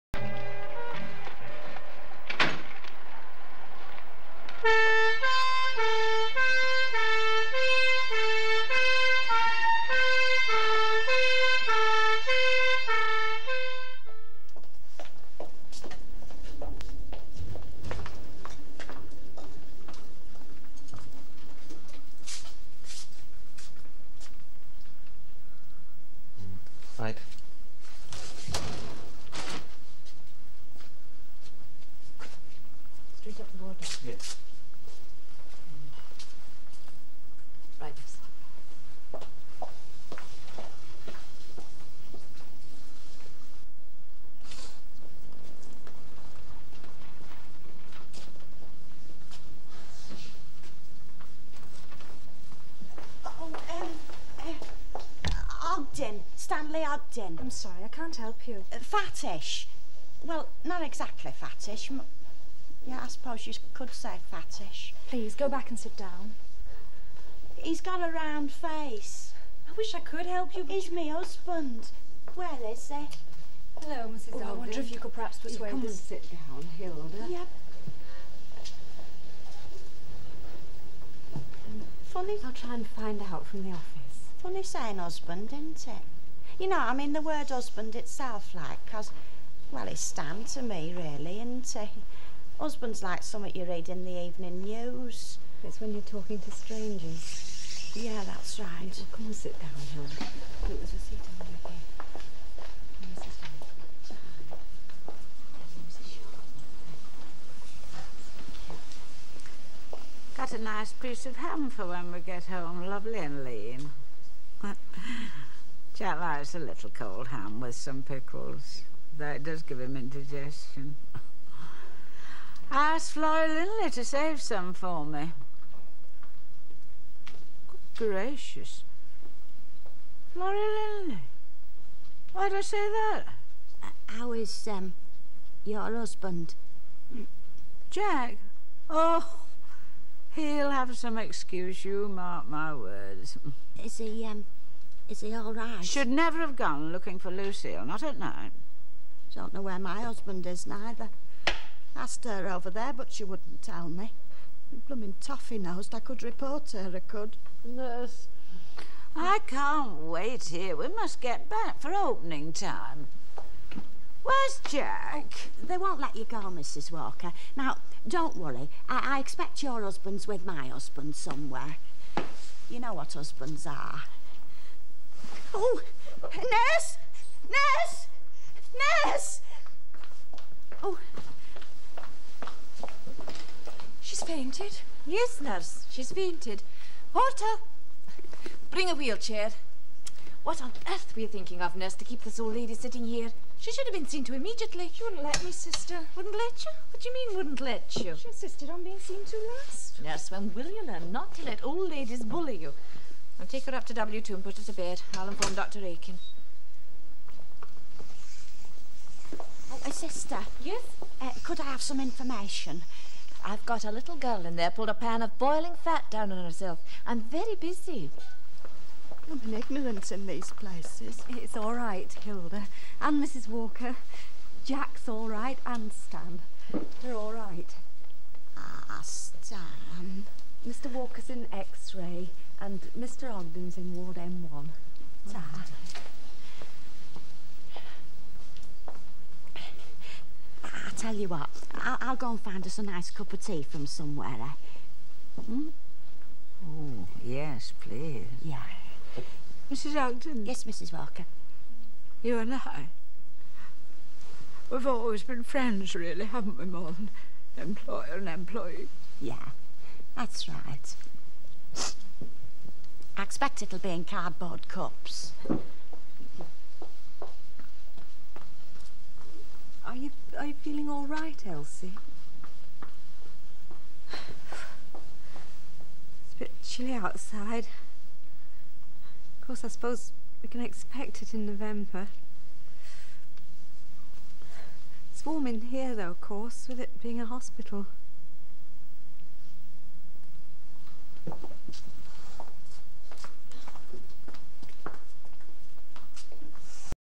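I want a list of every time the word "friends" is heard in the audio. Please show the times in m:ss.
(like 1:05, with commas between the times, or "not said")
4:15.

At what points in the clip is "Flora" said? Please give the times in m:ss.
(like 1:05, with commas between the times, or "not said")
2:03, 2:10.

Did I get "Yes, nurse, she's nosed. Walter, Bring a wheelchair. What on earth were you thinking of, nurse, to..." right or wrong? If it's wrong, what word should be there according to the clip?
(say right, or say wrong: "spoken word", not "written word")
wrong: "fainted", not "nosed".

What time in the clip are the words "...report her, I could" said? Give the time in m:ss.
2:36.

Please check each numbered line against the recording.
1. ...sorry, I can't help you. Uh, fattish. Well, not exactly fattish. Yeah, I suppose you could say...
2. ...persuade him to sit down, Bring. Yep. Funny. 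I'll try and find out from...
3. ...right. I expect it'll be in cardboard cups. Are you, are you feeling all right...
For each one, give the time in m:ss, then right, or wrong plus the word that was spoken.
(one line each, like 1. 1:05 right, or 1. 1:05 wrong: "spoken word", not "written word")
1. 0:57 right
2. 1:15 wrong: "Hilda", not "Bring"
3. 4:20 right.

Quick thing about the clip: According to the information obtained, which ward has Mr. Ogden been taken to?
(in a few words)
Ward M1.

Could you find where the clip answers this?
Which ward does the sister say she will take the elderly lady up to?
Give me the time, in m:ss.
3:23.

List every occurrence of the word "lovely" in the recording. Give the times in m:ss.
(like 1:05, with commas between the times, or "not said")
1:52.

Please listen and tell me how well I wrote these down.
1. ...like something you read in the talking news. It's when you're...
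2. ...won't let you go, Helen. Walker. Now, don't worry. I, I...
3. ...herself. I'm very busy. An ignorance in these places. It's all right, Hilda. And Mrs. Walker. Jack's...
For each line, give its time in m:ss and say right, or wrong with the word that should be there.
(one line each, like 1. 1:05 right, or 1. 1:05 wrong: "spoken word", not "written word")
1. 1:33 wrong: "evening", not "talking"
2. 2:45 wrong: "Mrs", not "Helen"
3. 3:36 right.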